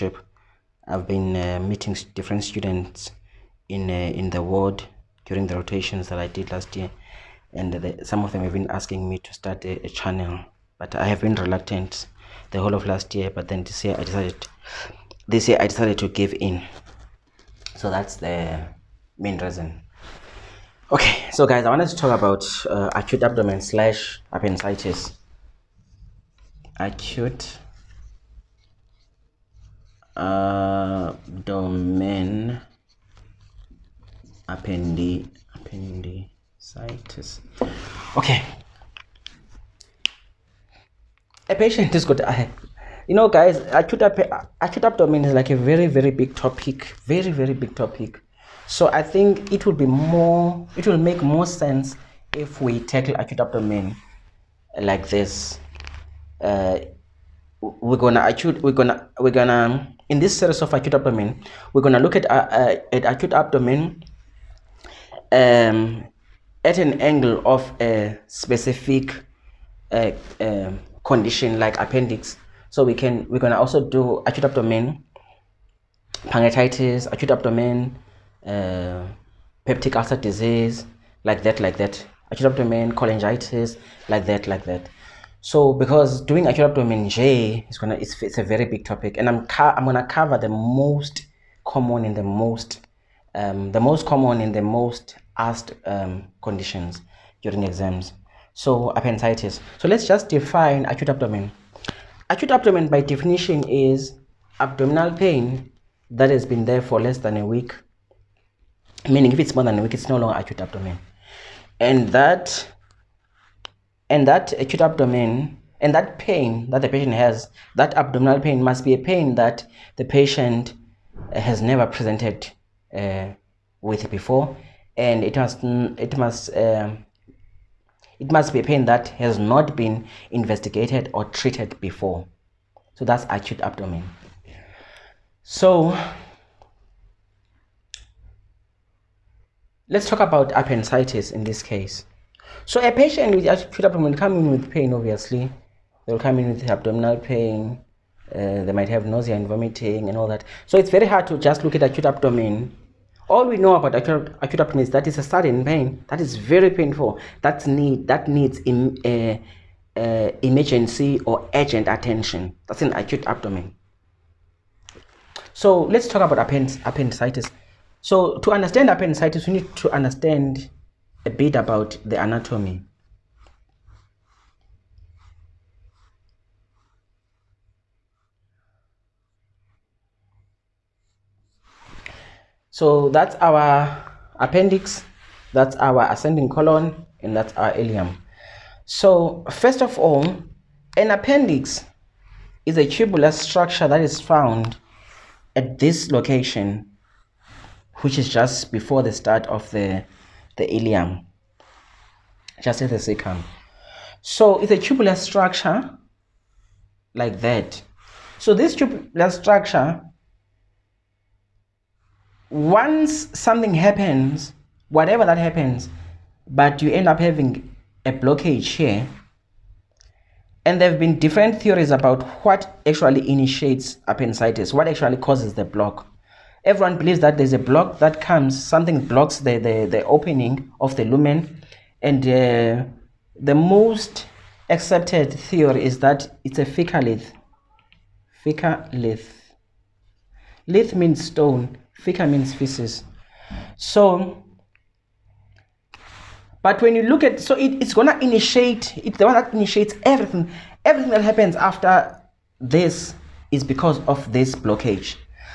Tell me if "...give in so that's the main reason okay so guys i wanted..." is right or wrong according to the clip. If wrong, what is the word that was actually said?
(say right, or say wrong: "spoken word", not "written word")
right.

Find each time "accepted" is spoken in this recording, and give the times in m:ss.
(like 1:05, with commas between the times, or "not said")
3:54.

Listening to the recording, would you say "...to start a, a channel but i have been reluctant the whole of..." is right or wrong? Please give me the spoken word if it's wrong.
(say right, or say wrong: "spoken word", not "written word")
right.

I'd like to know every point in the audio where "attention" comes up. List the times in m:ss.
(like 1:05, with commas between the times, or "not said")
2:41.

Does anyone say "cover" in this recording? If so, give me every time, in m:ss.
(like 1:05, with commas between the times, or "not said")
1:30.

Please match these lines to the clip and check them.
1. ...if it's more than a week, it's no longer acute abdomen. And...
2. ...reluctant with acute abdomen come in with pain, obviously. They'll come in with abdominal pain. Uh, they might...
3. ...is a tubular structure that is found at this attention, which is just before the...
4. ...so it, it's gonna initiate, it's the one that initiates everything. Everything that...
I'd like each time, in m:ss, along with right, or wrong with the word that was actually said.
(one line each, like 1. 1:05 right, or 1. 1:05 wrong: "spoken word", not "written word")
1. 1:49 right
2. 2:22 wrong: "patient", not "reluctant"
3. 3:12 wrong: "location", not "attention"
4. 4:07 right.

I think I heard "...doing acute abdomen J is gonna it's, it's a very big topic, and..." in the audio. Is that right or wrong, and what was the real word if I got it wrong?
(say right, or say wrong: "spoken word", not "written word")
right.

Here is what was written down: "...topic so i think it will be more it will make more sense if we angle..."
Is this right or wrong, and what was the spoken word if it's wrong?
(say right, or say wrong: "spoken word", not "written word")
wrong: "tackle", not "angle".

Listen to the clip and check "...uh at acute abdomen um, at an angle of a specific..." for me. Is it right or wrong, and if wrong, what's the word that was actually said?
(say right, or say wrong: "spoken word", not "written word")
right.